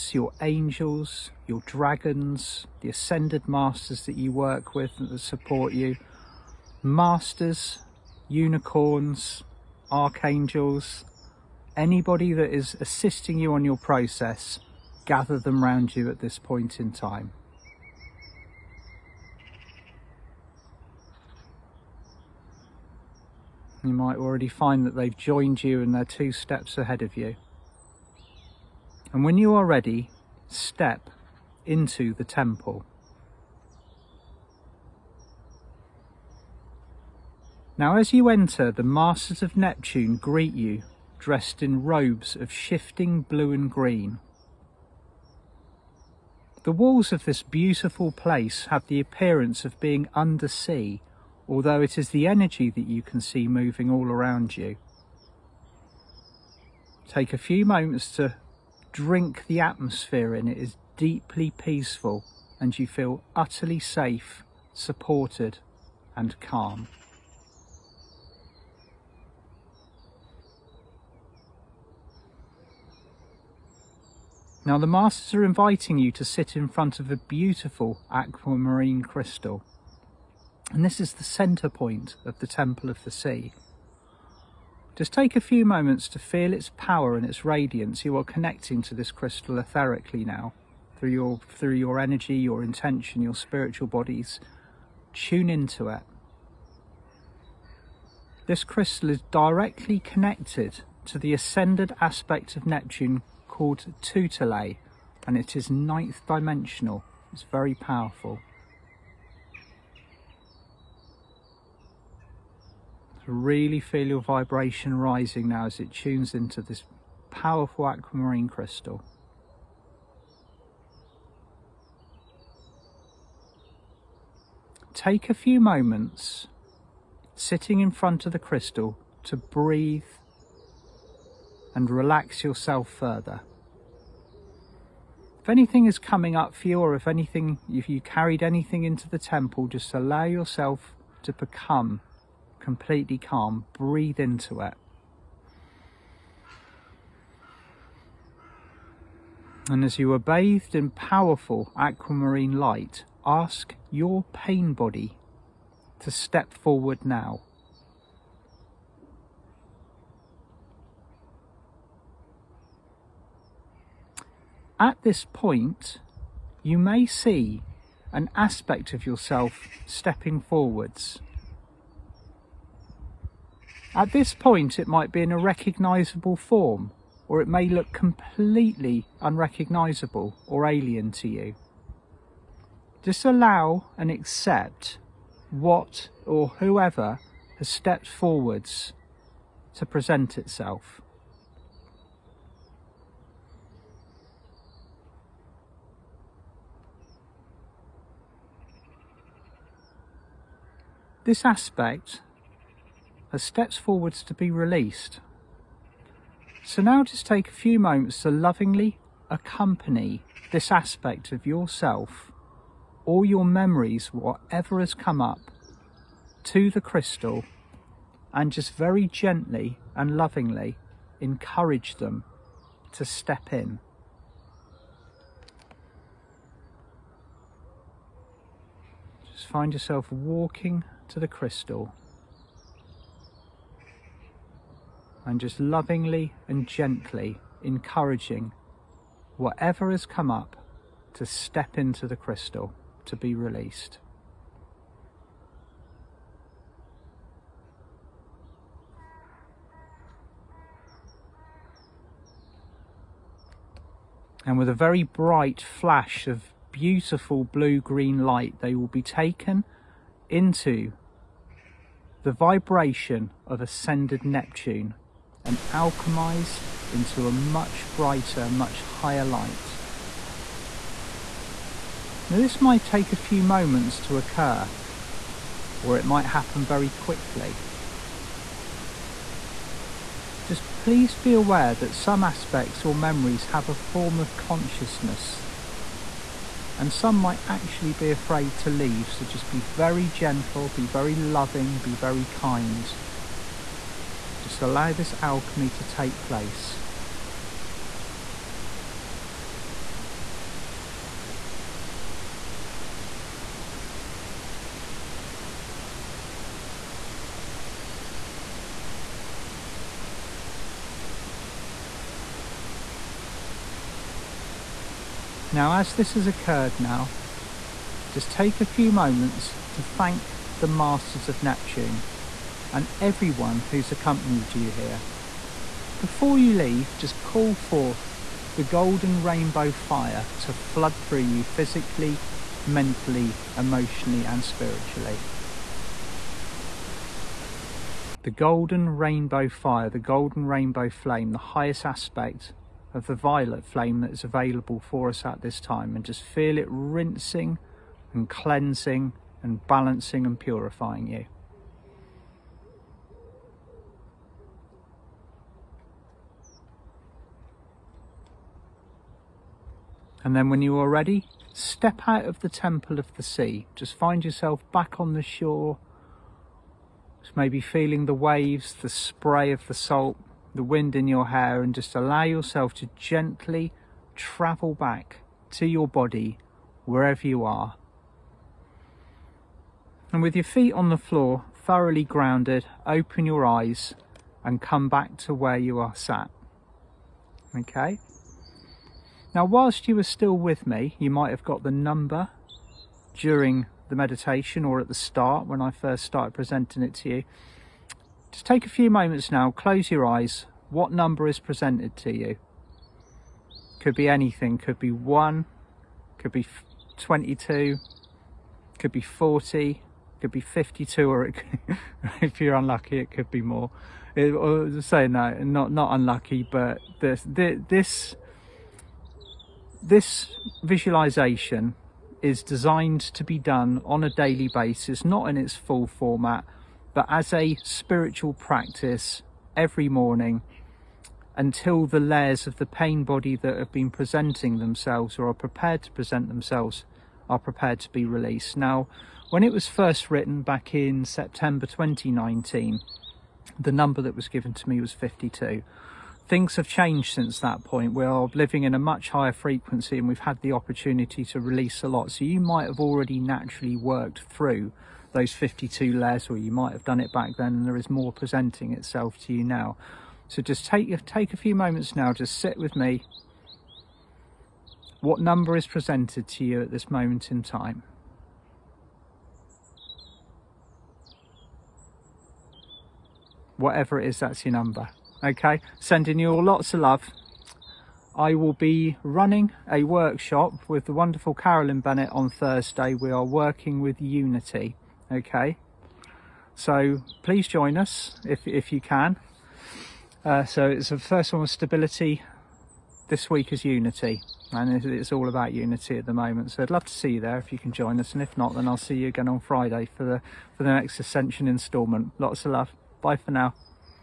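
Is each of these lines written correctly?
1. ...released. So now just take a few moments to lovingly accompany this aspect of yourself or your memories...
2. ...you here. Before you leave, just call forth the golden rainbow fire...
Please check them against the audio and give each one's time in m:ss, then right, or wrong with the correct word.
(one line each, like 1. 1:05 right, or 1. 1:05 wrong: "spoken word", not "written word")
1. 3:24 right
2. 5:24 right.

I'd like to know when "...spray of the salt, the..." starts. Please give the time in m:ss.
6:08.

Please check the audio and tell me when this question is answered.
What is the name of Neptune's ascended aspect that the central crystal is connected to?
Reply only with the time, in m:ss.
1:44.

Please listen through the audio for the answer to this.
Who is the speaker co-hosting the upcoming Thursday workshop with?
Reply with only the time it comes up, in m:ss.
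8:01.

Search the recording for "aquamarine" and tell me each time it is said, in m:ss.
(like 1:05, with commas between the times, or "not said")
1:18, 1:57, 2:31.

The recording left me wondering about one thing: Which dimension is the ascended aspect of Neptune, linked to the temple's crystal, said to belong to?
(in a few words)
ninth.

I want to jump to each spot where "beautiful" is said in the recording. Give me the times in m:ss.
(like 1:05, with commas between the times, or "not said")
0:47, 1:17, 4:16.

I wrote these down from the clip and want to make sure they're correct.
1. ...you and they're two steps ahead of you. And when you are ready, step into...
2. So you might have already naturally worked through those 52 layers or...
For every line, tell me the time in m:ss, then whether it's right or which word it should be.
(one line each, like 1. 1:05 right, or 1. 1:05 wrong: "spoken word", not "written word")
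1. 0:25 right
2. 7:32 right.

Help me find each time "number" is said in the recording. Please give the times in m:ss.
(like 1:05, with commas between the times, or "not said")
6:31, 6:40, 7:23, 7:45, 7:54.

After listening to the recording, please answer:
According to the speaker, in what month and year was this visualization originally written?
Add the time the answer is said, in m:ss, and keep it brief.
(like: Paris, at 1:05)
September 2019, at 7:21.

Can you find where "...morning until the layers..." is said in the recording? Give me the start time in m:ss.
7:09.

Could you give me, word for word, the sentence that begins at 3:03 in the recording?
Just allow and accept what or whoever has stepped forwards to present itself.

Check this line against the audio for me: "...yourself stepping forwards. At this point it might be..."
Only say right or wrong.
right.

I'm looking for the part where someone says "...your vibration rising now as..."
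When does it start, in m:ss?
1:54.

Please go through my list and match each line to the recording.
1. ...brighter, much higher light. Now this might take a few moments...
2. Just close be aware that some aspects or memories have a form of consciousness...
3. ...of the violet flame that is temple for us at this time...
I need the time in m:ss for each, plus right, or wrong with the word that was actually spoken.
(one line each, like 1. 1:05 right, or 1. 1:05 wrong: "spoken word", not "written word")
1. 4:27 right
2. 4:40 wrong: "please", not "close"
3. 5:42 wrong: "available", not "temple".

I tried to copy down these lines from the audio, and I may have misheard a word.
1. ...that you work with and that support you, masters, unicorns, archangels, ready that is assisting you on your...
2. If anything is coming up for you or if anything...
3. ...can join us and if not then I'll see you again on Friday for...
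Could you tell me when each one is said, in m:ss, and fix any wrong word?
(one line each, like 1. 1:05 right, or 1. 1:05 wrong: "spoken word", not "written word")
1. 0:04 wrong: "anybody", not "ready"
2. 2:15 right
3. 8:17 right.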